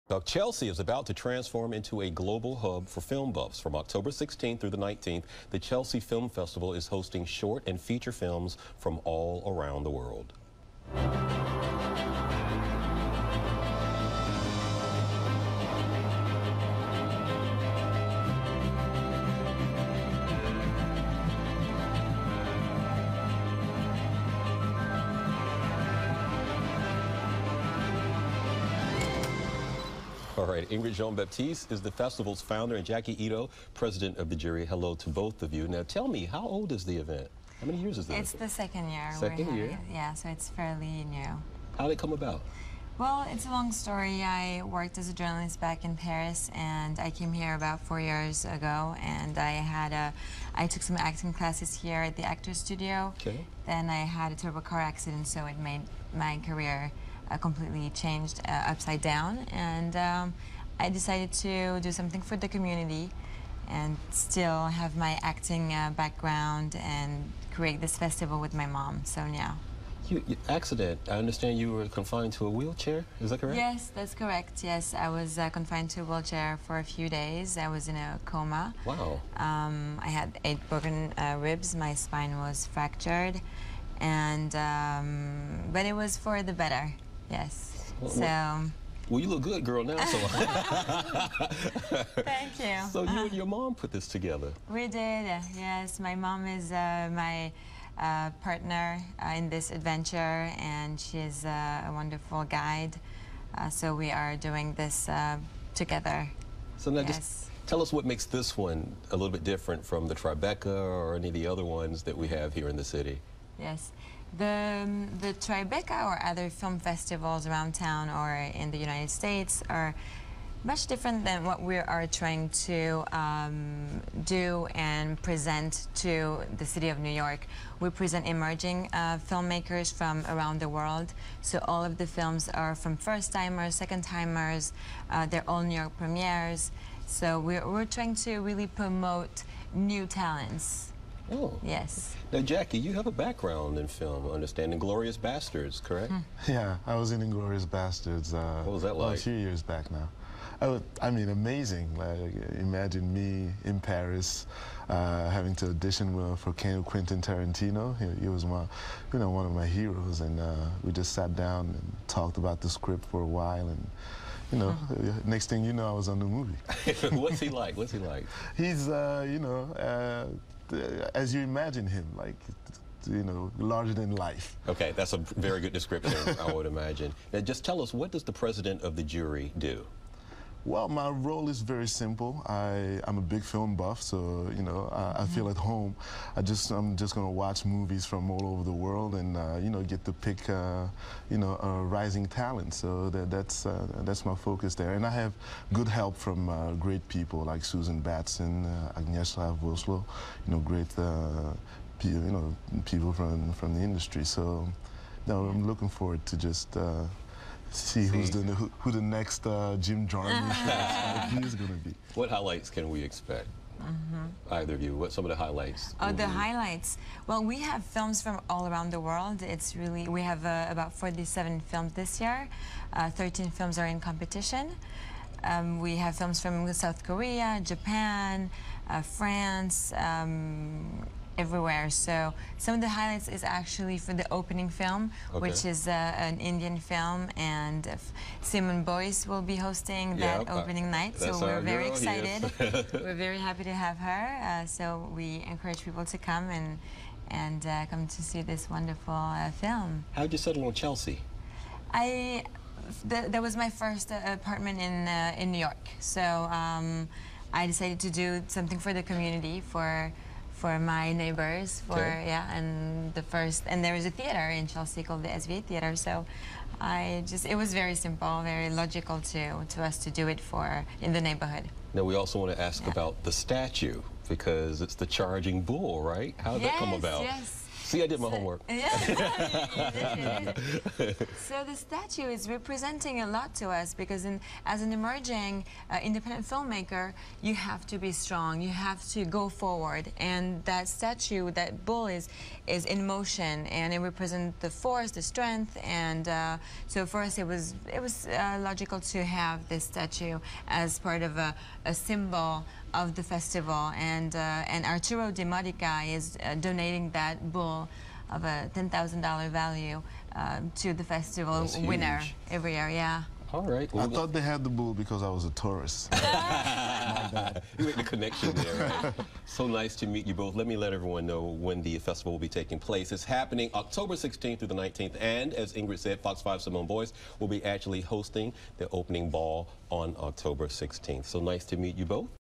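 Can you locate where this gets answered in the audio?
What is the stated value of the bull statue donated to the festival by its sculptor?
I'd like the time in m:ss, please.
5:08.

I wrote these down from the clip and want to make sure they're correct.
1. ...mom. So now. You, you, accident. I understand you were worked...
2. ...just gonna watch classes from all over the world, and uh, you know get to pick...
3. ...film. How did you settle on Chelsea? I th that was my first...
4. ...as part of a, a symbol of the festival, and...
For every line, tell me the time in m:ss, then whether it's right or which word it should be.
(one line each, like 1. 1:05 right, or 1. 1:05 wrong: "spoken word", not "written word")
1. 1:08 wrong: "confined", not "worked"
2. 3:06 wrong: "movies", not "classes"
3. 4:09 right
4. 5:00 right.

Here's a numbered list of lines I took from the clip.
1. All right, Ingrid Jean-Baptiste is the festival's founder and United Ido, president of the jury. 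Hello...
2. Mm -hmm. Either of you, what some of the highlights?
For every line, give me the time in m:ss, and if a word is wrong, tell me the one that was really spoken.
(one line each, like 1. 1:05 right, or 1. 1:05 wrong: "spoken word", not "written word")
1. 0:30 wrong: "Jacky", not "United"
2. 3:33 right.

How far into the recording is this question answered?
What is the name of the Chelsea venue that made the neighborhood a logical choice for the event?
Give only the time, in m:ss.
4:25.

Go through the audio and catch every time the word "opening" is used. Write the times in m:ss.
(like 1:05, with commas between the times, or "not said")
3:54, 4:00, 5:28.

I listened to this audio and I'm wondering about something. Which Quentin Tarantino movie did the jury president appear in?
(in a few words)
Inglourious Basterds.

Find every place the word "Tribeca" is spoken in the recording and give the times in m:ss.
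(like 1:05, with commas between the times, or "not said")
1:50, 1:55.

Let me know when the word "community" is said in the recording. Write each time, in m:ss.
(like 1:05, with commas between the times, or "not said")
1:02, 4:19.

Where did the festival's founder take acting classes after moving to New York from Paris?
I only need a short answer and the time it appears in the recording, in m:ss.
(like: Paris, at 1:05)
Actors Studio, at 0:52.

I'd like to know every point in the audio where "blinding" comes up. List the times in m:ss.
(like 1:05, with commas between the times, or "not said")
not said.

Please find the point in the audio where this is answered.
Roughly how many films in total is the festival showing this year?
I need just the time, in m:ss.
3:40.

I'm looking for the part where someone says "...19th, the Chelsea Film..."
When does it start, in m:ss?
0:04.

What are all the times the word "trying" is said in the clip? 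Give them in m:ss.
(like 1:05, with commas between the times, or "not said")
2:02, 2:17.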